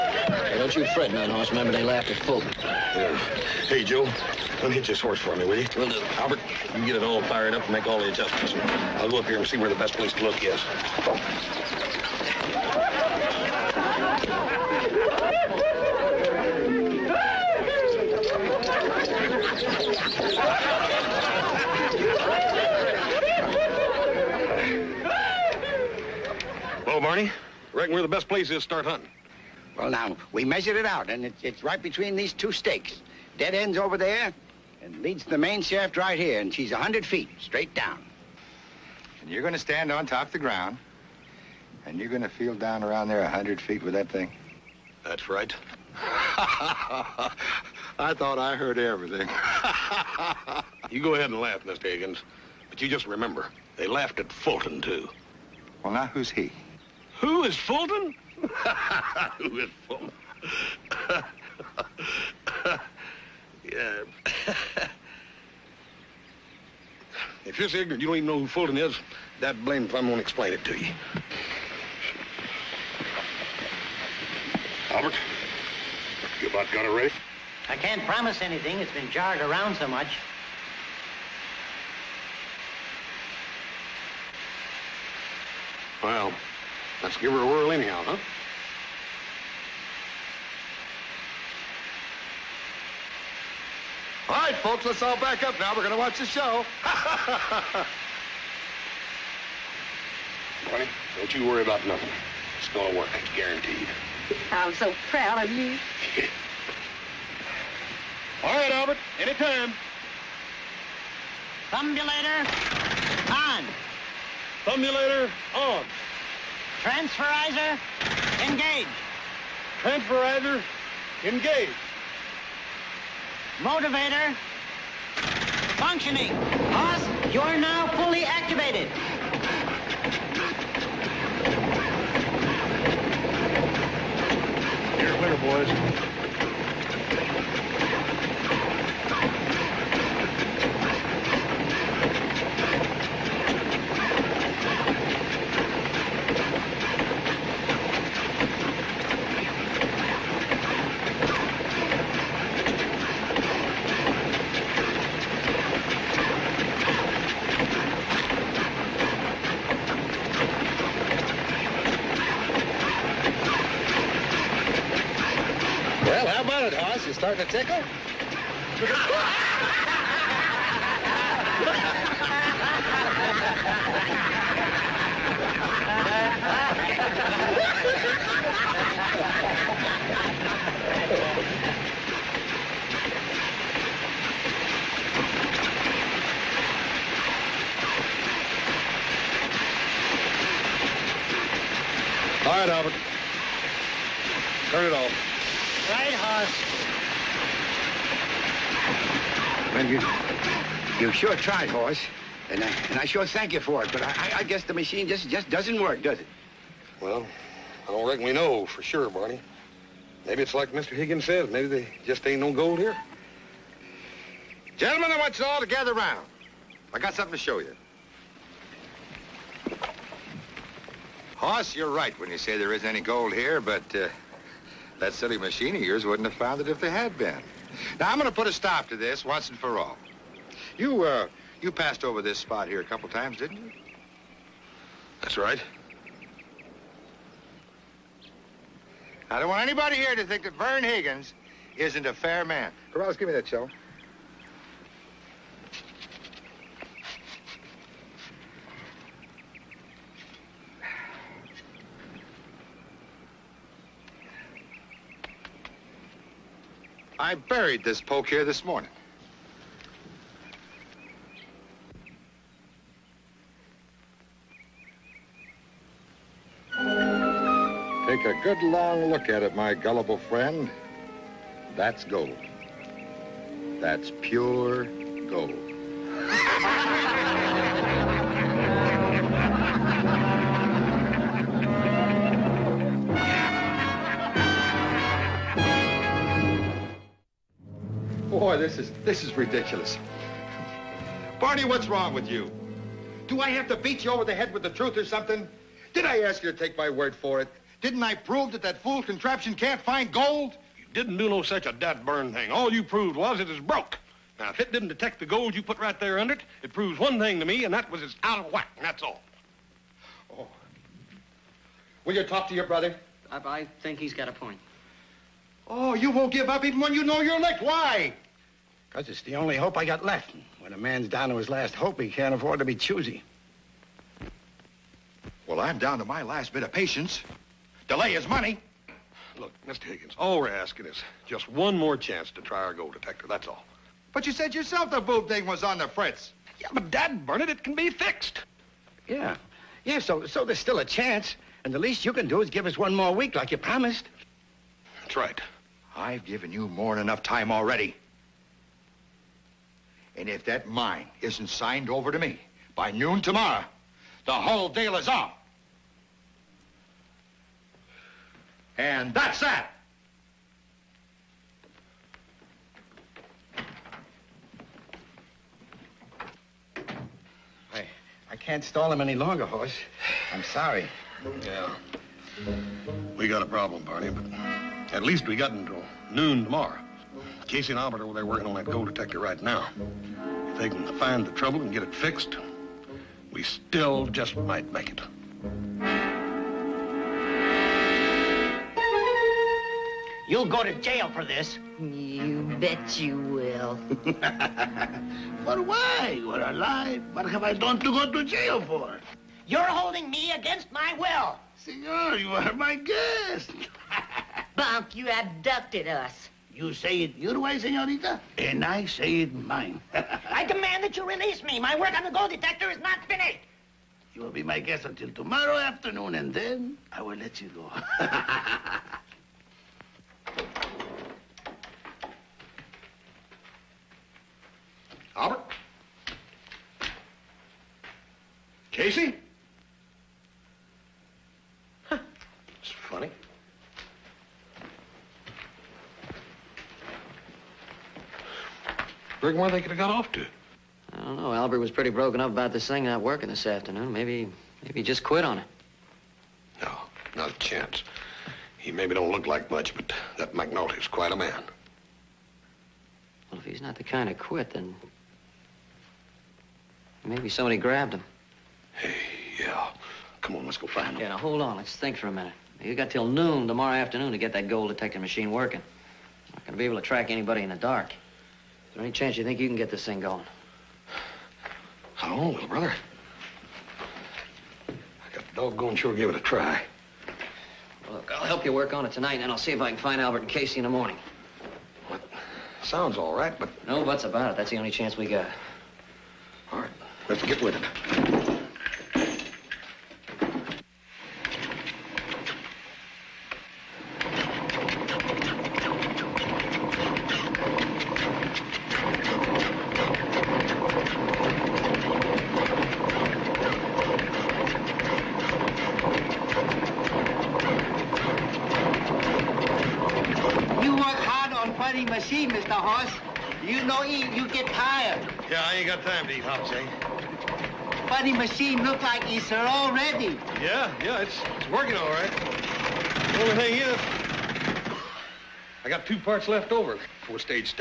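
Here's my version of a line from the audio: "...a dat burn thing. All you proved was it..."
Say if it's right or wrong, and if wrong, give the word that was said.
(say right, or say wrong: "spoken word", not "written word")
right.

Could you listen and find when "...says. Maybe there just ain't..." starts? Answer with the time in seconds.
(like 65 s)
211 s.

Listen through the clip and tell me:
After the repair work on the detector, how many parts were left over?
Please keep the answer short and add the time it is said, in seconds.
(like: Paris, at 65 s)
2, at 525 s.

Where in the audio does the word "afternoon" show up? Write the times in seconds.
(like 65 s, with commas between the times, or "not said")
415 s, 443 s, 463 s.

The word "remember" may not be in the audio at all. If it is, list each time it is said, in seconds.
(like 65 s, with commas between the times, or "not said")
1 s, 53 s.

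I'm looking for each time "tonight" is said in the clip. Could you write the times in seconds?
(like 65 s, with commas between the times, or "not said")
478 s.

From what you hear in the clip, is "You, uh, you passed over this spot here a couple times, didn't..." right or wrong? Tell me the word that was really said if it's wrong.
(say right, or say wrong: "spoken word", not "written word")
right.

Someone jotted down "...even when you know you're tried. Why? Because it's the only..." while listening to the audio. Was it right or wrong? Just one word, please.
wrong.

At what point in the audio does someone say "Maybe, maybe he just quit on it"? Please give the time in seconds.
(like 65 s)
443 s.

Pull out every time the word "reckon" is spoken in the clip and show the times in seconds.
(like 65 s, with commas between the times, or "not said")
27 s, 208 s.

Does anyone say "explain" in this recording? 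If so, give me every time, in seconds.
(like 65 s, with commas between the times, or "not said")
70 s.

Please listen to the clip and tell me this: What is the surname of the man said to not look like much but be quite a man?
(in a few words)
McNulty.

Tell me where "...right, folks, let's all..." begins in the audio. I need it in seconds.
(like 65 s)
94 s.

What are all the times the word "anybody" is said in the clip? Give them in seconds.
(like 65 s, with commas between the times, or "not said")
239 s, 467 s.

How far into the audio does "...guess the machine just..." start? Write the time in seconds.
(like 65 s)
204 s.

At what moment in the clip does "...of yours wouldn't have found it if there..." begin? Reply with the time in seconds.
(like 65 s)
225 s.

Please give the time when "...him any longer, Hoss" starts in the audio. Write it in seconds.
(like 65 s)
368 s.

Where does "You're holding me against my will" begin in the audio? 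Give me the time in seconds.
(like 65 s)
399 s.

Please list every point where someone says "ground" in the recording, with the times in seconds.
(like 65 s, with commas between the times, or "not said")
40 s.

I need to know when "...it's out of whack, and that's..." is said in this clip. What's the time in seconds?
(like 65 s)
308 s.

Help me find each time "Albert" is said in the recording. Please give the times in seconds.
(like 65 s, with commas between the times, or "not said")
6 s, 74 s, 108 s, 377 s, 425 s, 441 s, 480 s.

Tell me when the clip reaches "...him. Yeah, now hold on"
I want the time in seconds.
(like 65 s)
460 s.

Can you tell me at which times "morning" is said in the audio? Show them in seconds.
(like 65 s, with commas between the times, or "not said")
258 s, 480 s.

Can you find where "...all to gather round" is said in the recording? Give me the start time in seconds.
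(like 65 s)
215 s.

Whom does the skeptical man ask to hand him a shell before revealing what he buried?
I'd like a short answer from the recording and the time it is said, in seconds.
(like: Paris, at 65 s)
Corrales, at 242 s.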